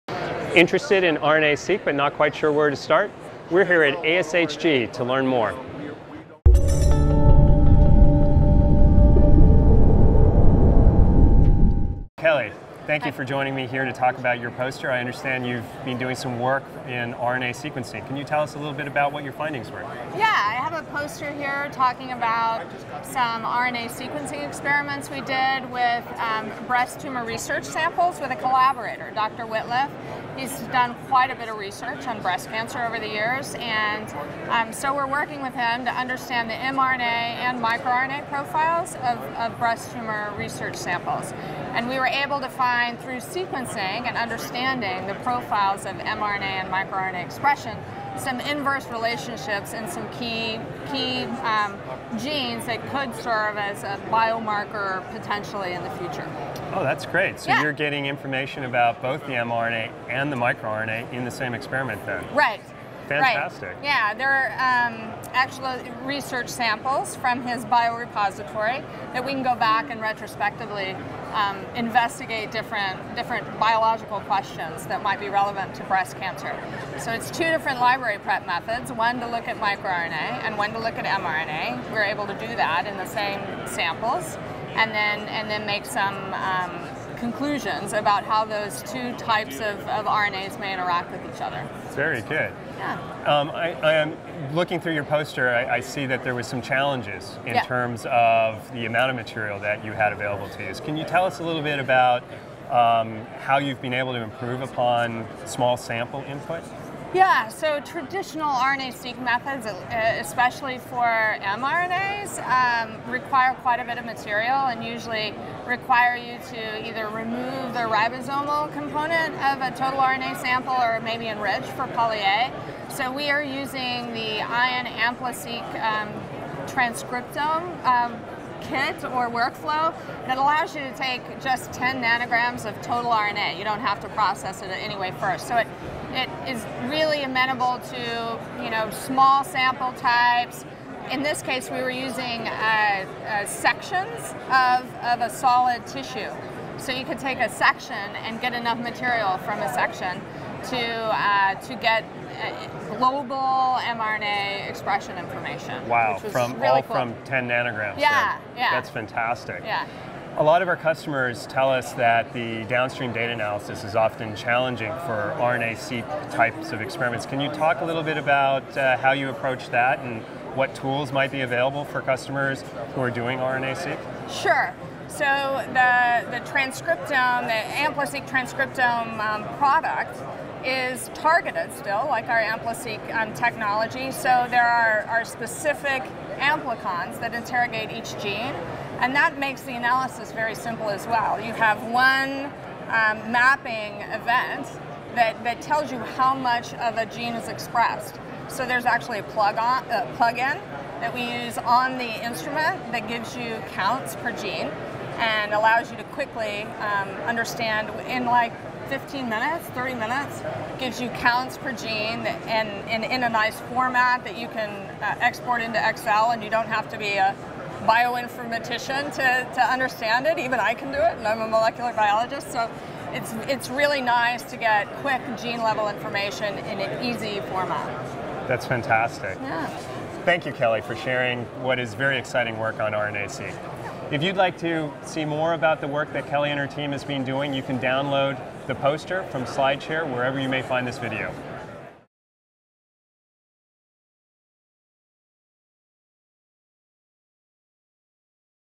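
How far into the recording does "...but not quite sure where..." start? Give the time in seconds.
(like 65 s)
1 s.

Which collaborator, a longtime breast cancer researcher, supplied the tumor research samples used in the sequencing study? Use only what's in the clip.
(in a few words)
Dr. Wittliff.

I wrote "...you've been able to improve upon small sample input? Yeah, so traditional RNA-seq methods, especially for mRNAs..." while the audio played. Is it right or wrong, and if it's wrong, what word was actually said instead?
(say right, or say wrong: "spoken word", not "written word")
right.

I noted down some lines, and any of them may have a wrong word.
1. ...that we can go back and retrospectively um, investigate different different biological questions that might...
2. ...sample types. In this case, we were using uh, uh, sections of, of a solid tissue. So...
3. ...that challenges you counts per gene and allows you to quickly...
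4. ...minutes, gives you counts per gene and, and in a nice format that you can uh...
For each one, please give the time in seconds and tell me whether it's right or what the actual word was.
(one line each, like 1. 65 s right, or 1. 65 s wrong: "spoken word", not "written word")
1. 69 s right
2. 139 s right
3. 202 s wrong: "gives", not "challenges"
4. 209 s right.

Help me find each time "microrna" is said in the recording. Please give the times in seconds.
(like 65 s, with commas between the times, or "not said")
37 s, 46 s, 60 s, 79 s.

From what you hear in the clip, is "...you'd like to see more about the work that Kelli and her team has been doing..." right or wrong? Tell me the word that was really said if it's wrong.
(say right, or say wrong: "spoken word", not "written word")
right.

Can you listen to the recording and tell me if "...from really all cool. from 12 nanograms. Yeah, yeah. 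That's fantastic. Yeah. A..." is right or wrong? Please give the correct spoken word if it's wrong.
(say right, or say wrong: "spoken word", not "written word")
wrong: "10", not "12".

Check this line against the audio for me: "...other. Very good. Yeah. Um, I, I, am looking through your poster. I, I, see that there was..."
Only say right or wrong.
right.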